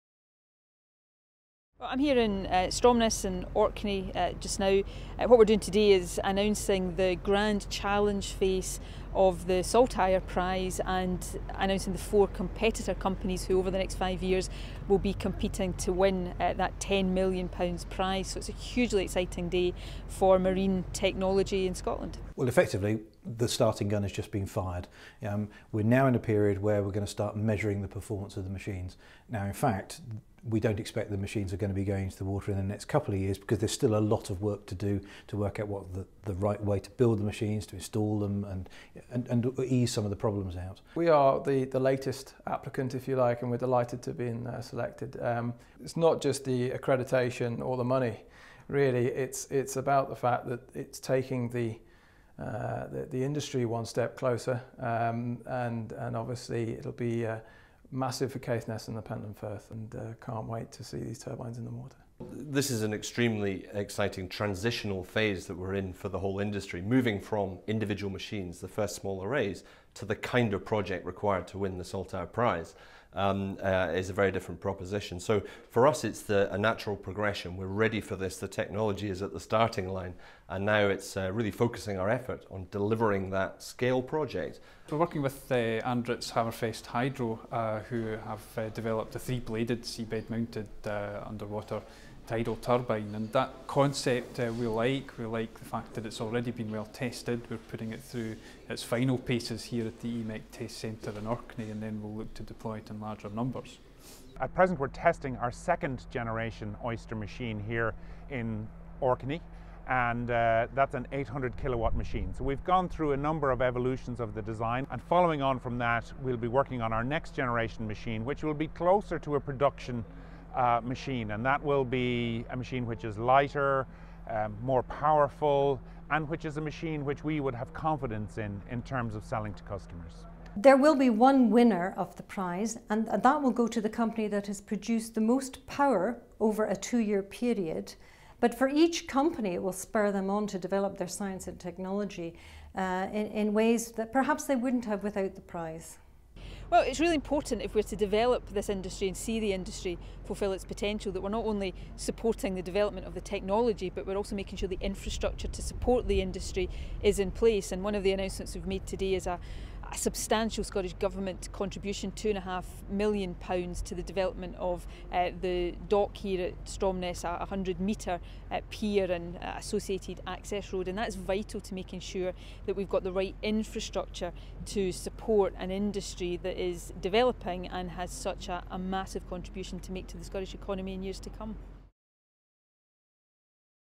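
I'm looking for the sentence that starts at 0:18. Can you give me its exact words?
So it's a hugely exciting day for marine technology in Scotland.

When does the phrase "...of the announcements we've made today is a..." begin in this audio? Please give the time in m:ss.
2:37.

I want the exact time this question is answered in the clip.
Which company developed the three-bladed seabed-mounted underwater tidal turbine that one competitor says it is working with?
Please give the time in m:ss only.
1:25.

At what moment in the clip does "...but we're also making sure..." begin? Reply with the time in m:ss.
2:33.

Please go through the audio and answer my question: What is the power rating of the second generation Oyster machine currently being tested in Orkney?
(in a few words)
800 kilowatts.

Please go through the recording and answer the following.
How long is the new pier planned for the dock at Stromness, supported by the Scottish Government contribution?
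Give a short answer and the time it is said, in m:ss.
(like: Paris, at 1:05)
100 metres, at 2:47.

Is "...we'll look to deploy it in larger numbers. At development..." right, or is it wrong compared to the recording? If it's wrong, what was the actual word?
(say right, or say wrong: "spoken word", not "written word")
wrong: "present", not "development".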